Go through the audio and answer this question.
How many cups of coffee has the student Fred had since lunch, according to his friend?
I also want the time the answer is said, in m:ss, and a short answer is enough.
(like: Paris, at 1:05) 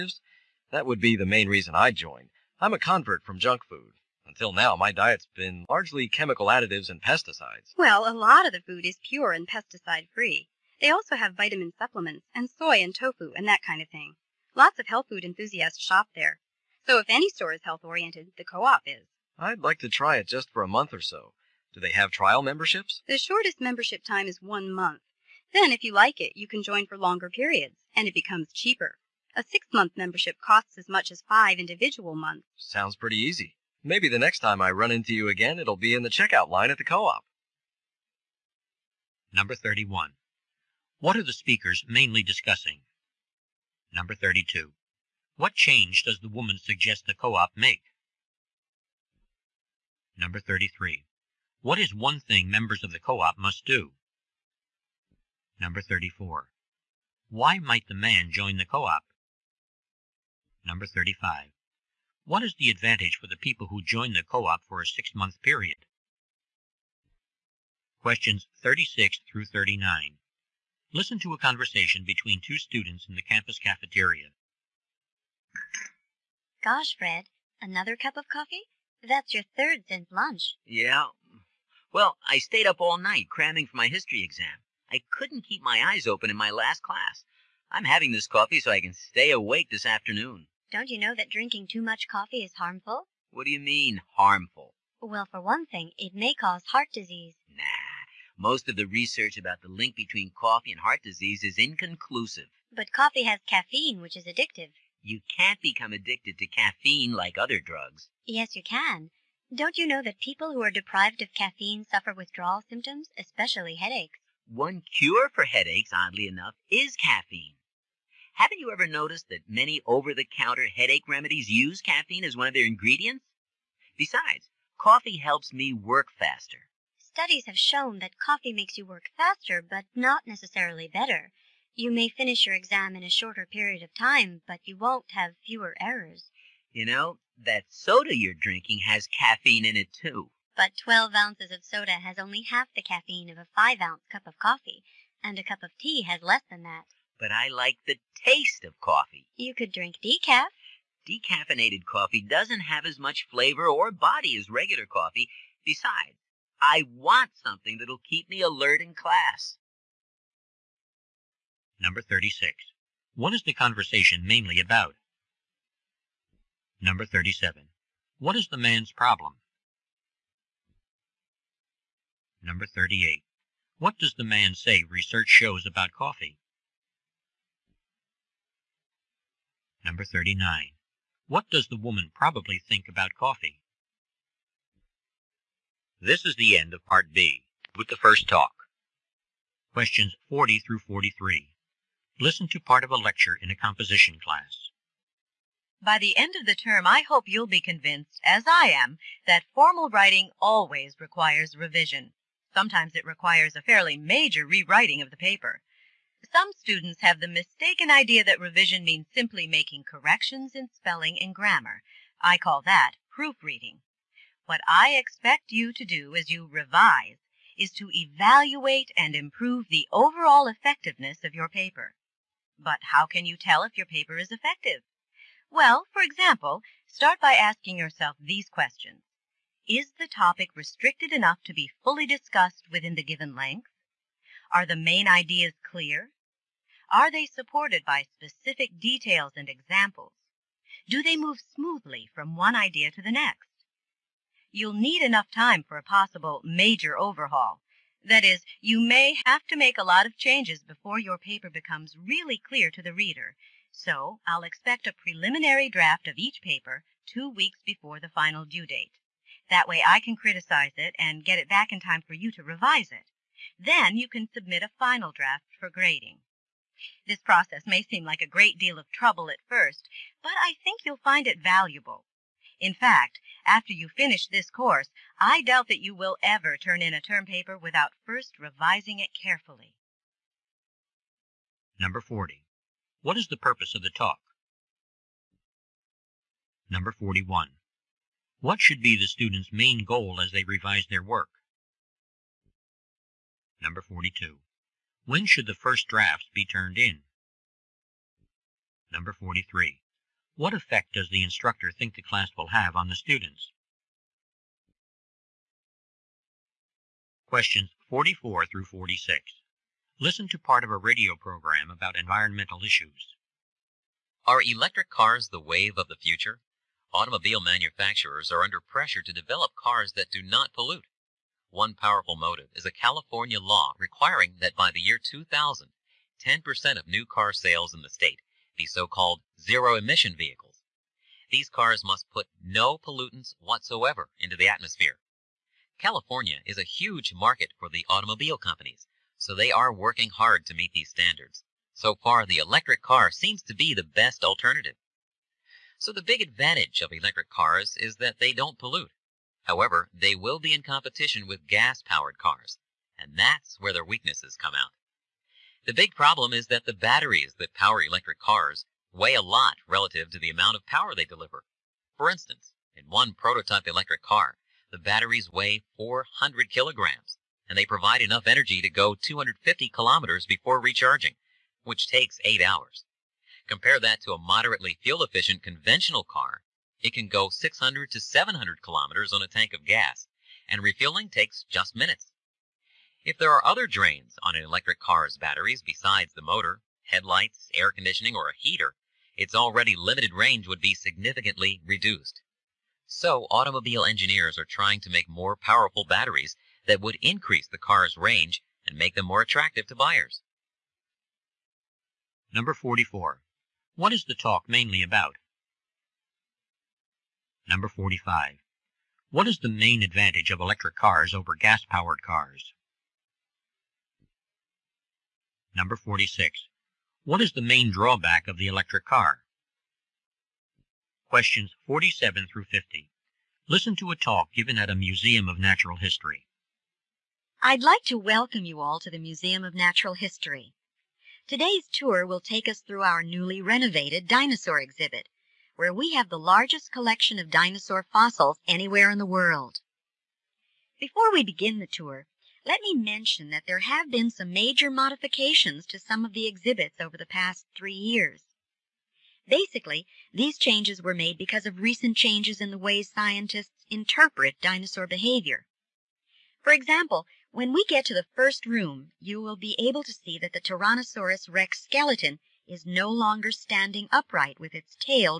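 3, at 1:19.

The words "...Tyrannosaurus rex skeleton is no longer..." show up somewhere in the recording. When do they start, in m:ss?
7:40.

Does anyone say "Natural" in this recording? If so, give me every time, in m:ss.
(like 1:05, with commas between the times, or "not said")
7:05, 7:09.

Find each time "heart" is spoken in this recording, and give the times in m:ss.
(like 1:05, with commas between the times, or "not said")
1:36, 1:40.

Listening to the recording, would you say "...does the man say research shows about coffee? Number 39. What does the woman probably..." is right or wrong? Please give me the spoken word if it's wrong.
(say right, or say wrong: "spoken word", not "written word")
right.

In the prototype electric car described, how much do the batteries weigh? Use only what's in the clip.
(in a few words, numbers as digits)
400 kilograms.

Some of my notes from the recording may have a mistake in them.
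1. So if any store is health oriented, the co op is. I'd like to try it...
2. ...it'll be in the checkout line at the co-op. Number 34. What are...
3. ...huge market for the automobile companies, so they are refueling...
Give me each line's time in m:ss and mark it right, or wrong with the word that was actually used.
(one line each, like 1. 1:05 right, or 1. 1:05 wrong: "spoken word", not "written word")
1. 0:16 right
2. 0:35 wrong: "31", not "34"
3. 5:36 wrong: "working", not "refueling".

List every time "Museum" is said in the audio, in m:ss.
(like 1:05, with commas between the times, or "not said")
7:04, 7:08.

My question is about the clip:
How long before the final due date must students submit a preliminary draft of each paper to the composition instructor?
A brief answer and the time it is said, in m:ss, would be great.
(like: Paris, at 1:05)
2 weeks, at 4:17.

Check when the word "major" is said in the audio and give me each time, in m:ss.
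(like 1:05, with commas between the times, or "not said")
3:23, 4:06, 7:24.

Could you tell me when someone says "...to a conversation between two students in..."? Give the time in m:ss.
1:11.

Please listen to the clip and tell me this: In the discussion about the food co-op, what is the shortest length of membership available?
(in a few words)
1 month.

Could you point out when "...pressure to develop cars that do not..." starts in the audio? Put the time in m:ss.
5:18.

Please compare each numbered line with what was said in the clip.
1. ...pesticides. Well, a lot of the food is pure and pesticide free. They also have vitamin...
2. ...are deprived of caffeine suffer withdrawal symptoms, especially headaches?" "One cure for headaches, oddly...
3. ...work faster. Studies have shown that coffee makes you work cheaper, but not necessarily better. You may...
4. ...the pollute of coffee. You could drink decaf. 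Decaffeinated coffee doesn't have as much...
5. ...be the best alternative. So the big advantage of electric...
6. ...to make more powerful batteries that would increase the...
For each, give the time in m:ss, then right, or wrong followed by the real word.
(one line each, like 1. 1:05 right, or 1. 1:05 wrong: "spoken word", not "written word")
1. 0:07 right
2. 1:50 right
3. 2:05 wrong: "faster", not "cheaper"
4. 2:27 wrong: "taste", not "pollute"
5. 5:43 right
6. 6:34 right.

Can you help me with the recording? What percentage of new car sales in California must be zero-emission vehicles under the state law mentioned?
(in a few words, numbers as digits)
10%.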